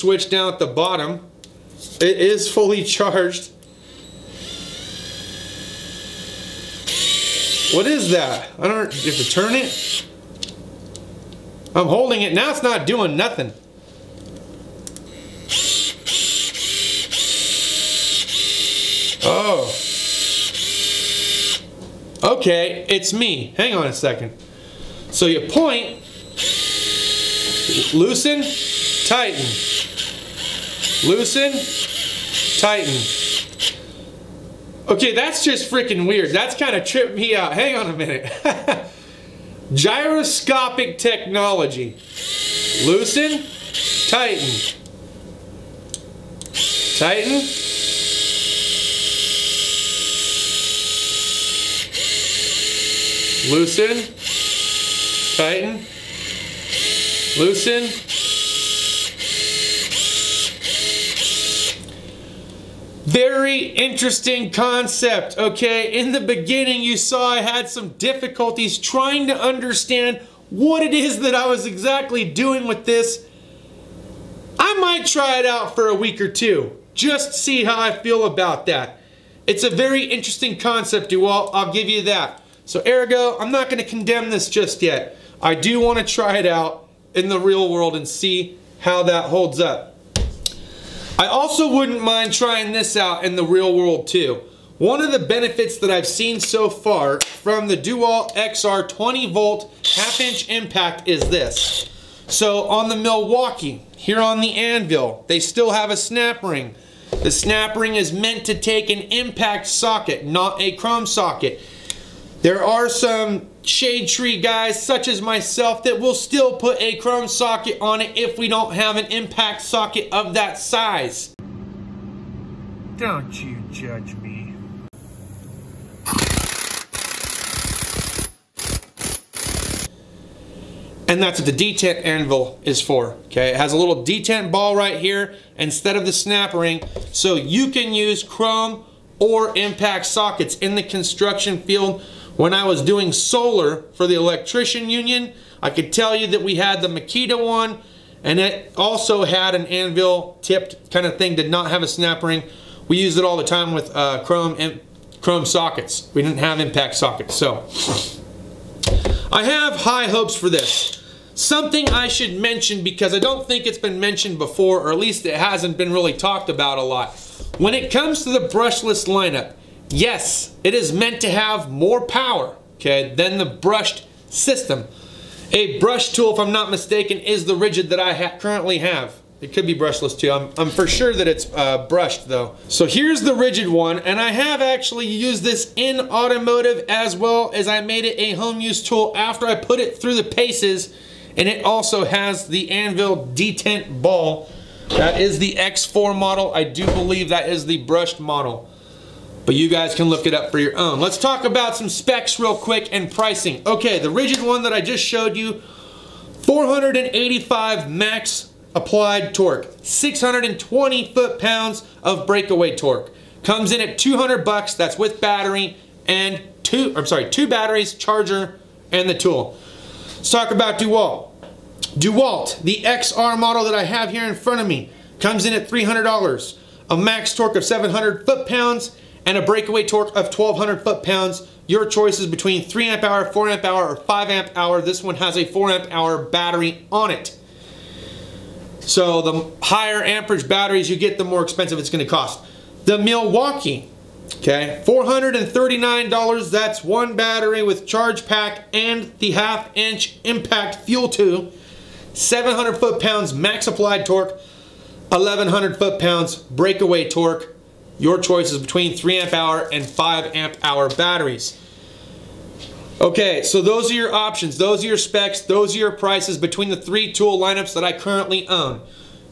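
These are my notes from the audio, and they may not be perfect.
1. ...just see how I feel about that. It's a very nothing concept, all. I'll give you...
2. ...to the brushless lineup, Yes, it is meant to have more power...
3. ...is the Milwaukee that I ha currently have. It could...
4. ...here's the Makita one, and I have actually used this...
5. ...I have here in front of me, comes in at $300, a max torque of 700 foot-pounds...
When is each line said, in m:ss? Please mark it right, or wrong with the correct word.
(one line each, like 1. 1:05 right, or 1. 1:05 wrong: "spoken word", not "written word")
1. 1:16 wrong: "interesting", not "nothing"
2. 2:48 right
3. 2:57 wrong: "Ridgid", not "Milwaukee"
4. 3:02 wrong: "Ridgid", not "Makita"
5. 3:43 right.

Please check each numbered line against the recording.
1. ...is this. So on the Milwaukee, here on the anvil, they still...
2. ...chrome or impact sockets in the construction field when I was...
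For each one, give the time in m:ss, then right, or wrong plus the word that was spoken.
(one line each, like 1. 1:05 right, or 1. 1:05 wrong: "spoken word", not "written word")
1. 1:41 right
2. 2:18 right.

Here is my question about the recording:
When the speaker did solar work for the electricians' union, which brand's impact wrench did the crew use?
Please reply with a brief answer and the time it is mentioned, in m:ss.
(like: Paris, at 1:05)
Makita, at 2:26.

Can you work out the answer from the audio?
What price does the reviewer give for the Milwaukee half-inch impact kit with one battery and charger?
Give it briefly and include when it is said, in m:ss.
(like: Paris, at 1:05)
$439, at 4:04.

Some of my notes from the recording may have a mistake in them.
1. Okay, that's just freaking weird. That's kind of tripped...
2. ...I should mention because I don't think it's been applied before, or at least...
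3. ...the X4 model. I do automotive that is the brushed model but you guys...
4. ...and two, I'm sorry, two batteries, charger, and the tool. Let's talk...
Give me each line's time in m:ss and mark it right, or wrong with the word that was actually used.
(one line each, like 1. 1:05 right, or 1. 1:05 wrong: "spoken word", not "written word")
1. 0:34 right
2. 2:41 wrong: "mentioned", not "applied"
3. 3:15 wrong: "believe", not "automotive"
4. 3:36 right.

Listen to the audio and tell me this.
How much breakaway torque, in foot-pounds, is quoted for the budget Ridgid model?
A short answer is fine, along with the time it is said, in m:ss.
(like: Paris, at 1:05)
620, at 3:29.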